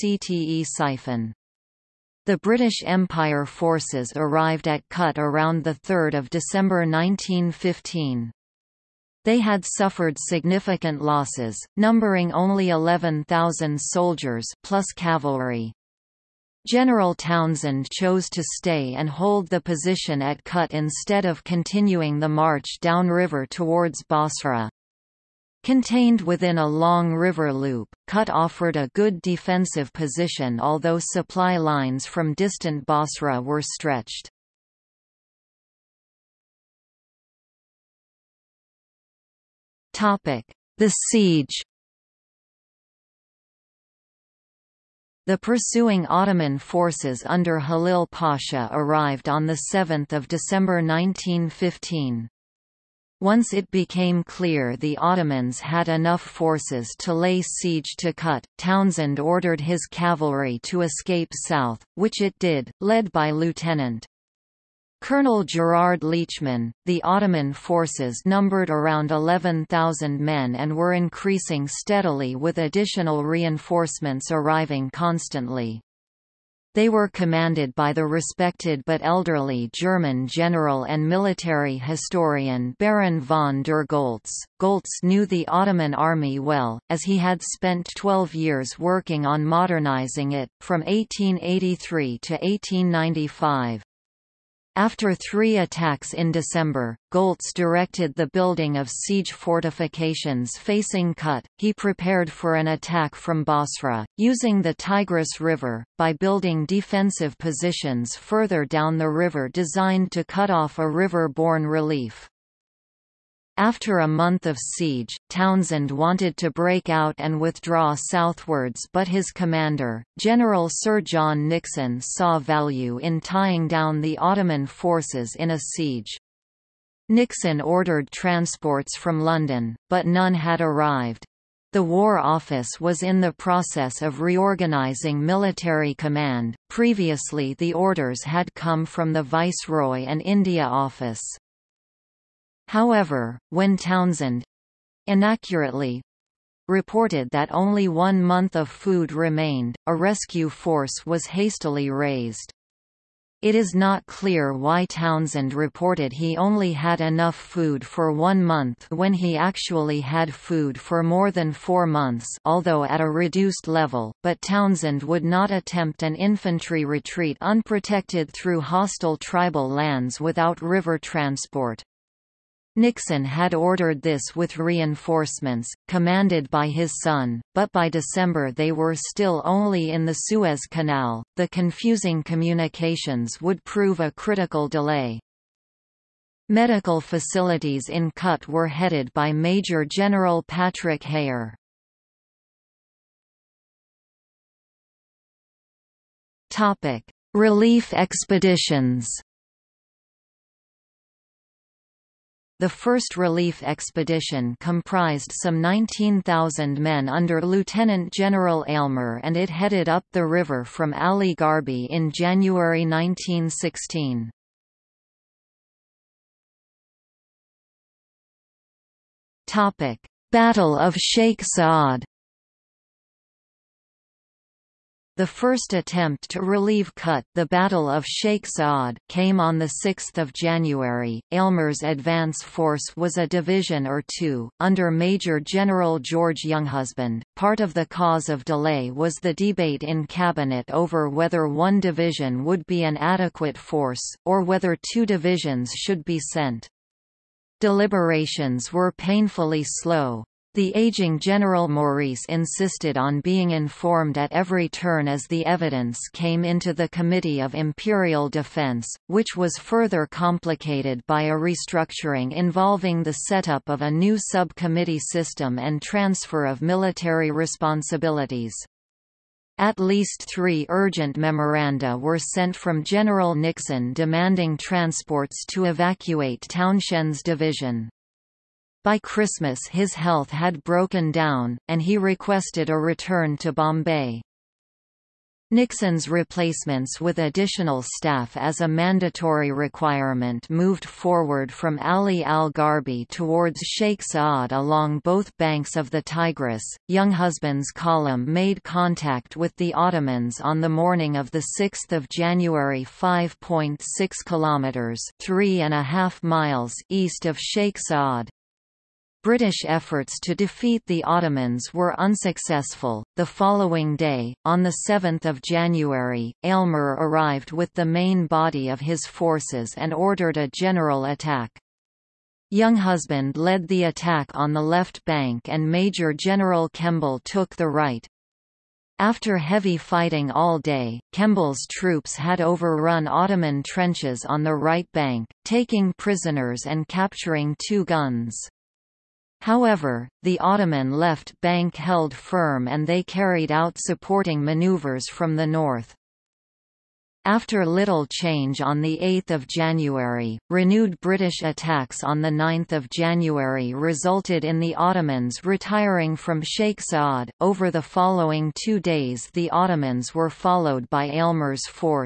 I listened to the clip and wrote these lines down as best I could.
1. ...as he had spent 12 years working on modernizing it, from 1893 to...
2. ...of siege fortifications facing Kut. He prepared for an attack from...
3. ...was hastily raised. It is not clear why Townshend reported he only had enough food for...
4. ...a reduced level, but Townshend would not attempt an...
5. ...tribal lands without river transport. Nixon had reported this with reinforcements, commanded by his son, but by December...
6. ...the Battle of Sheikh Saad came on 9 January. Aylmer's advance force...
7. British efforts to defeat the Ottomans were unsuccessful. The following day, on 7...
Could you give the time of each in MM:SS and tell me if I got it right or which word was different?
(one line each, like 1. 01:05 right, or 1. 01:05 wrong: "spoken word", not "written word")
1. 01:26 wrong: "1883", not "1893"
2. 01:38 right
3. 02:31 right
4. 02:43 right
5. 02:49 wrong: "ordered", not "reported"
6. 03:47 wrong: "6", not "9"
7. 05:09 right.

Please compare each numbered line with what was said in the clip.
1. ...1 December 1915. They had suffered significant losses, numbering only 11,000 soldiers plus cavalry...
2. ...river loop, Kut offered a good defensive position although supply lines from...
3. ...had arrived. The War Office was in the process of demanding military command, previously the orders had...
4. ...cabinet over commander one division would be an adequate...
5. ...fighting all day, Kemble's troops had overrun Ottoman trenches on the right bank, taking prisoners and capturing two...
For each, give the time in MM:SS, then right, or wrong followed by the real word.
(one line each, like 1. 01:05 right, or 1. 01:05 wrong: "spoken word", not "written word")
1. 00:05 wrong: "3", not "1"
2. 00:27 right
3. 02:10 wrong: "reorganizing", not "demanding"
4. 04:00 wrong: "whether", not "commander"
5. 05:29 right.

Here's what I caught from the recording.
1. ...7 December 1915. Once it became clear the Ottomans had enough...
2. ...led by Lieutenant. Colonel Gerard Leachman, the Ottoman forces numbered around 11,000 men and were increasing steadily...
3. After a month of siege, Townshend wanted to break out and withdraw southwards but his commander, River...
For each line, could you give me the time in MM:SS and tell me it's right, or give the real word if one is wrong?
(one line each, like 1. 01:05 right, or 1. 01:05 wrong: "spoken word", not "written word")
1. 00:49 right
2. 01:02 right
3. 01:53 wrong: "General", not "River".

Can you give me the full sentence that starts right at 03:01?
The confusing communications would prove a critical delay.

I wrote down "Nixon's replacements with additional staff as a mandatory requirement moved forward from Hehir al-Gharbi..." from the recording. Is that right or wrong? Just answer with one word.
wrong.